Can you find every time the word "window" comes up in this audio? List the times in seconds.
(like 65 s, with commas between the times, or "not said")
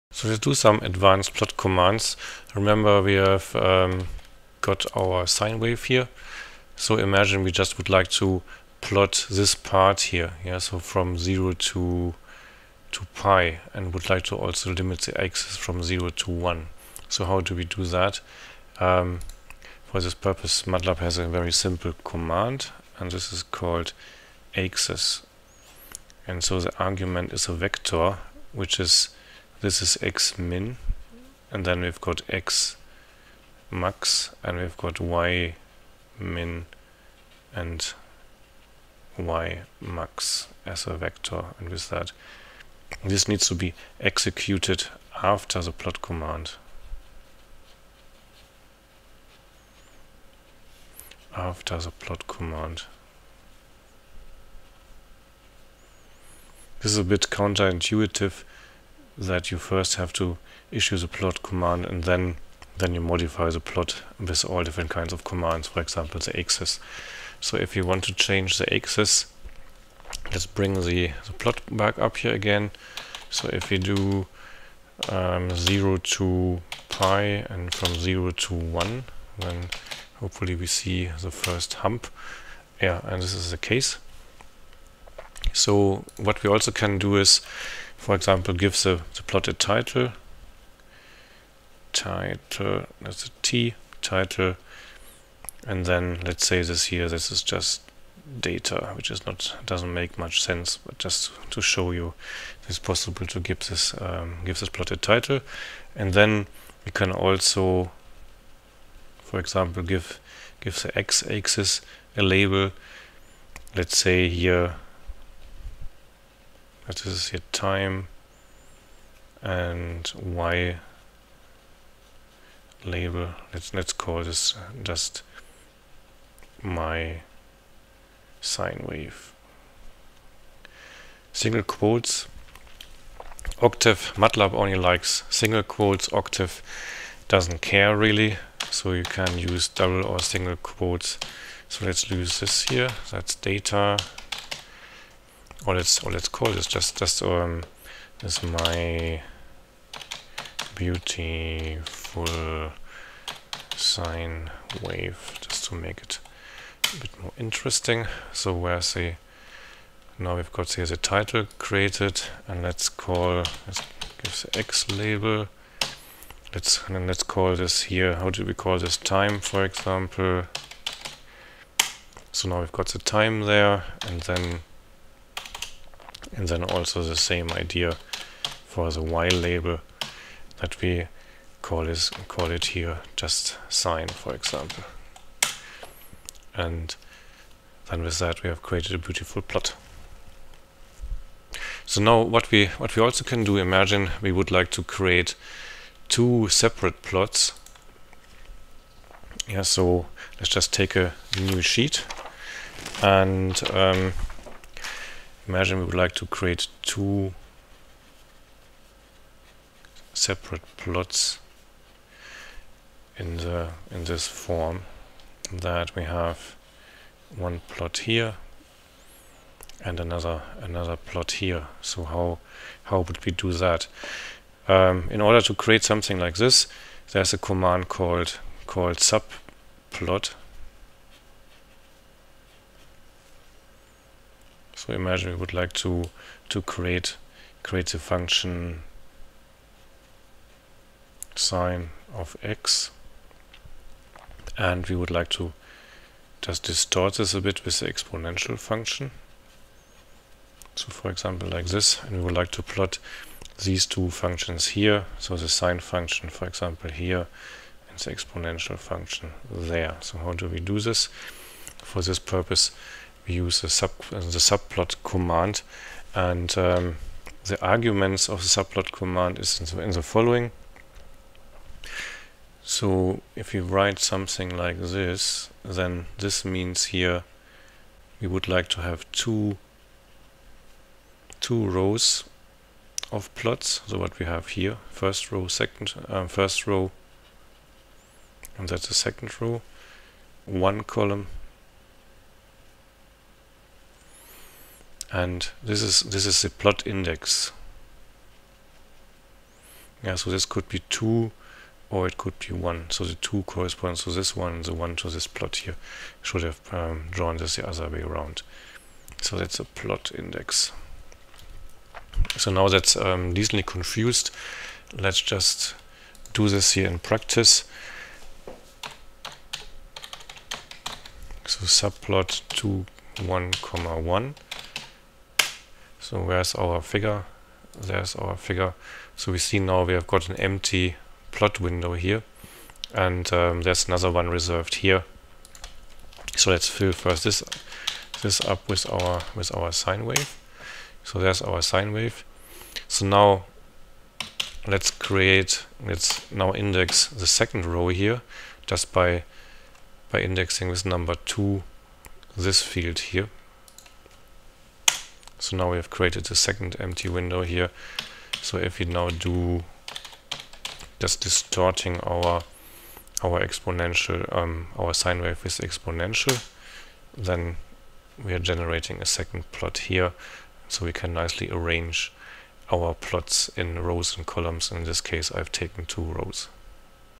331 s, 357 s.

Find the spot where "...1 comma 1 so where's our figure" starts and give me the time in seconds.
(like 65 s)
323 s.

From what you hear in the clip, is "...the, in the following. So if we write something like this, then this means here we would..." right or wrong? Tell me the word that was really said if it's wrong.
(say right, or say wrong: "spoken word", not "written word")
right.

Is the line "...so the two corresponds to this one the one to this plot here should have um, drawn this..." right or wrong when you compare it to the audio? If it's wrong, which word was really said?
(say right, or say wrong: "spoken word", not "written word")
right.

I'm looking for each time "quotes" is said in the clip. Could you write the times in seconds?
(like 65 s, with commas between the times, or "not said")
131 s, 135 s, 140 s.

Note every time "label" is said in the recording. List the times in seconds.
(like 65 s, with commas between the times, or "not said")
112 s, 122 s, 164 s, 179 s.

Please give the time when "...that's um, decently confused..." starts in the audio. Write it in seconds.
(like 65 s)
312 s.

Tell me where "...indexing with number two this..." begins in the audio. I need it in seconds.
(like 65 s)
350 s.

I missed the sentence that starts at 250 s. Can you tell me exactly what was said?
So for example like this and we would like to plot these two functions here.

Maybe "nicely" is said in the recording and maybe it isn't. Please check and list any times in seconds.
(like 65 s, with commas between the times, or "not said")
371 s.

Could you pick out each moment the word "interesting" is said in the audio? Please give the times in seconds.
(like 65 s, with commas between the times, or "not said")
157 s.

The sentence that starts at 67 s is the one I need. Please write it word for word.
So if you want to change the axis, let's bring the, the plot back up here again.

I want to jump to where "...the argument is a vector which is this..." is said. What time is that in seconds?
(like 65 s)
26 s.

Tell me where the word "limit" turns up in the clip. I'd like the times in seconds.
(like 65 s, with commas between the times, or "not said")
14 s.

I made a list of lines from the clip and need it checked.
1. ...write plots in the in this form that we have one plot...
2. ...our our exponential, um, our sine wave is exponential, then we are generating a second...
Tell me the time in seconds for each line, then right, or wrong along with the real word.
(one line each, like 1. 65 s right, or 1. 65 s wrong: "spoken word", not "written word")
1. 210 s wrong: "separate", not "write"
2. 362 s right.